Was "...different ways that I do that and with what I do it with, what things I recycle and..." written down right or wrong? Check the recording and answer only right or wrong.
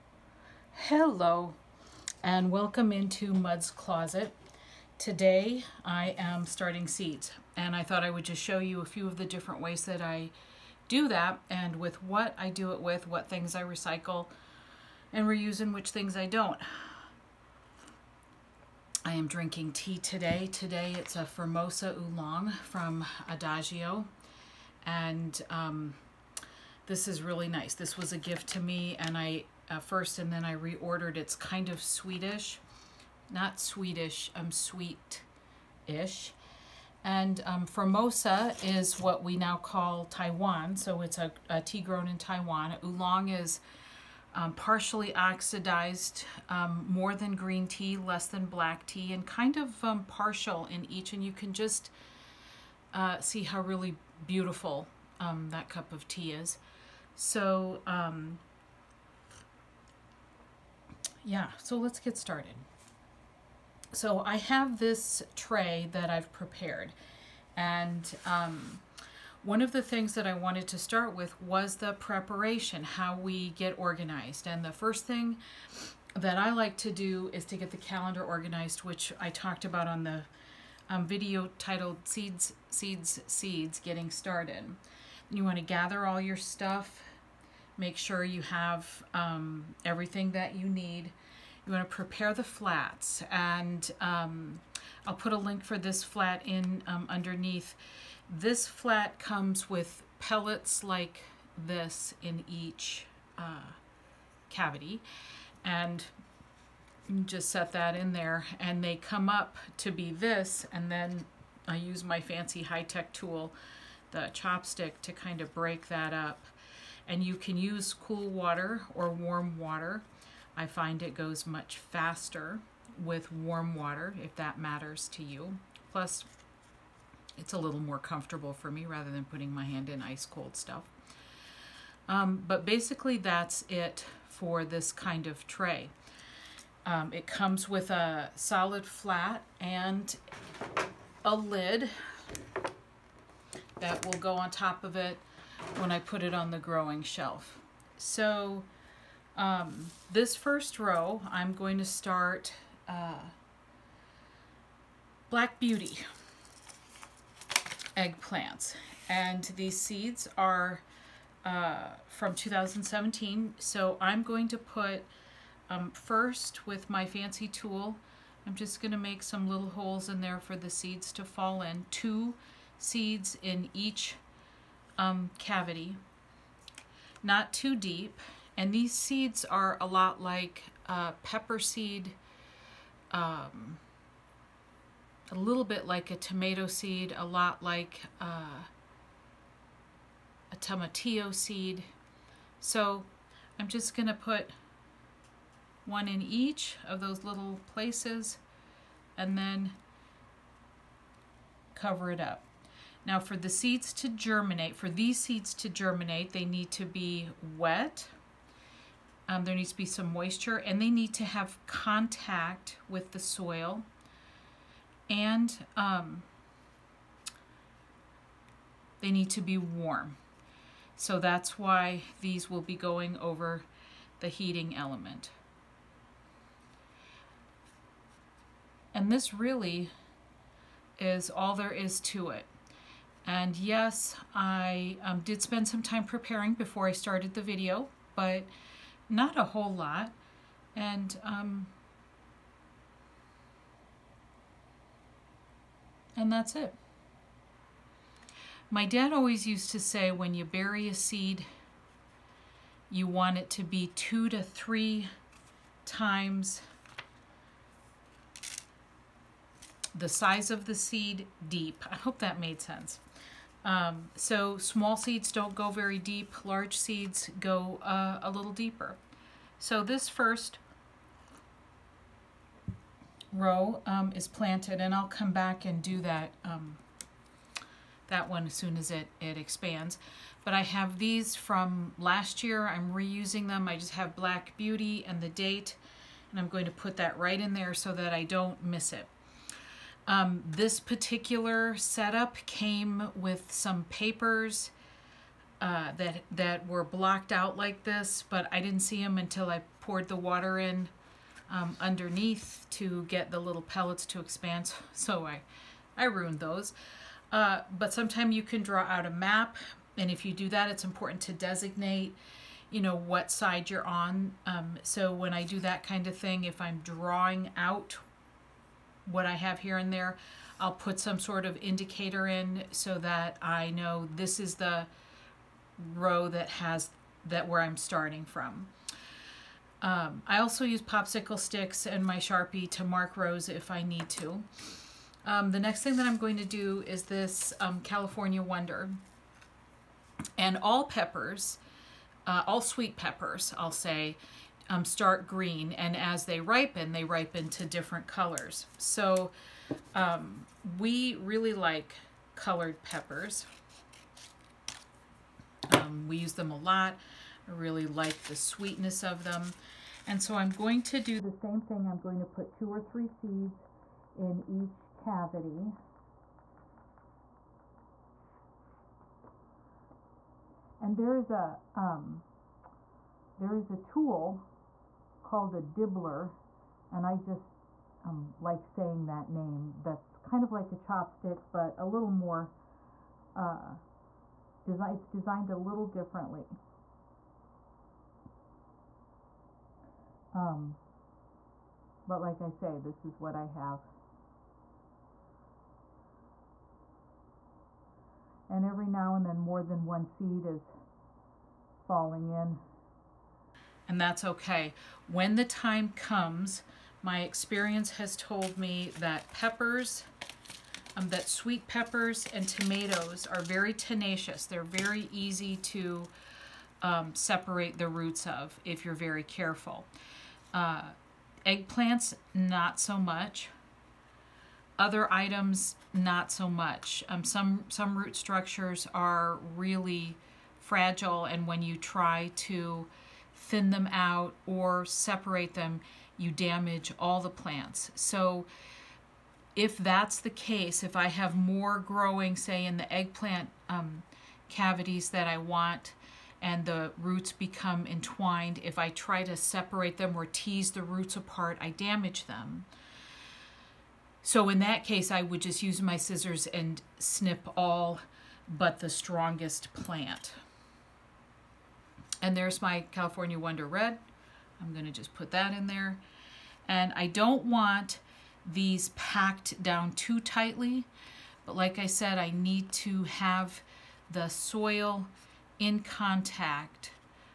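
right.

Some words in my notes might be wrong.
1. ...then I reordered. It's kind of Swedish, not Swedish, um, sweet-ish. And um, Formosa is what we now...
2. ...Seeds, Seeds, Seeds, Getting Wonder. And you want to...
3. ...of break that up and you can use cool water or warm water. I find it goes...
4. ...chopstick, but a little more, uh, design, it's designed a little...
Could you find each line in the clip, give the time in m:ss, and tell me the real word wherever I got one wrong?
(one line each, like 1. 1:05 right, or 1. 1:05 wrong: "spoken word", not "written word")
1. 0:30 right
2. 1:22 wrong: "Started", not "Wonder"
3. 1:55 right
4. 6:20 right.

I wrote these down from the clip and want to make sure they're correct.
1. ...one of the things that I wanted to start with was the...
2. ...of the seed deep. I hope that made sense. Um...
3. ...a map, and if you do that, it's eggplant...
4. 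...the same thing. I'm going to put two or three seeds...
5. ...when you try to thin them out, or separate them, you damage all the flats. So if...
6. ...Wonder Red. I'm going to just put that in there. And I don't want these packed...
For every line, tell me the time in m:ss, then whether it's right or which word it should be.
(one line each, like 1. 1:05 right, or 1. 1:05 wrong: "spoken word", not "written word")
1. 1:09 right
2. 4:20 right
3. 5:09 wrong: "important", not "eggplant"
4. 6:01 right
5. 7:11 wrong: "plants", not "flats"
6. 7:43 right.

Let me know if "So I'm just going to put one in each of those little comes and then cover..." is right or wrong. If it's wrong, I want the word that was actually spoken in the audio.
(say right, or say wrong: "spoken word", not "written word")
wrong: "places", not "comes".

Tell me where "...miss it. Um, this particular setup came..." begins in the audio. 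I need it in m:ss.
4:48.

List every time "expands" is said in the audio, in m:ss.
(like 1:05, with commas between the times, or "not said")
4:39, 5:04.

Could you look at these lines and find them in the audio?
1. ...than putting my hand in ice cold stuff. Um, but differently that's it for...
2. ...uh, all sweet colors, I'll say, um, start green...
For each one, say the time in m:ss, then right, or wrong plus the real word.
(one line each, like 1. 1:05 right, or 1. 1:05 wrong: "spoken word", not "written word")
1. 2:09 wrong: "basically", not "differently"
2. 5:42 wrong: "peppers", not "colors".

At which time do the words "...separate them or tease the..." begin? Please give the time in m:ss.
7:29.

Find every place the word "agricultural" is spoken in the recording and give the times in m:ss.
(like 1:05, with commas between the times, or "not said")
not said.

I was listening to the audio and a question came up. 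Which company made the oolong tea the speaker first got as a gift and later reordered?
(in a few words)
Adagio.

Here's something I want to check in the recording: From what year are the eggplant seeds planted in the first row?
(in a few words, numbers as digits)
2017.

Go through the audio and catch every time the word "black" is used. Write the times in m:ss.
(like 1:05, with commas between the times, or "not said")
0:48, 2:35, 4:44.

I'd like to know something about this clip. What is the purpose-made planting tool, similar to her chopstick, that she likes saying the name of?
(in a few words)
dibbler.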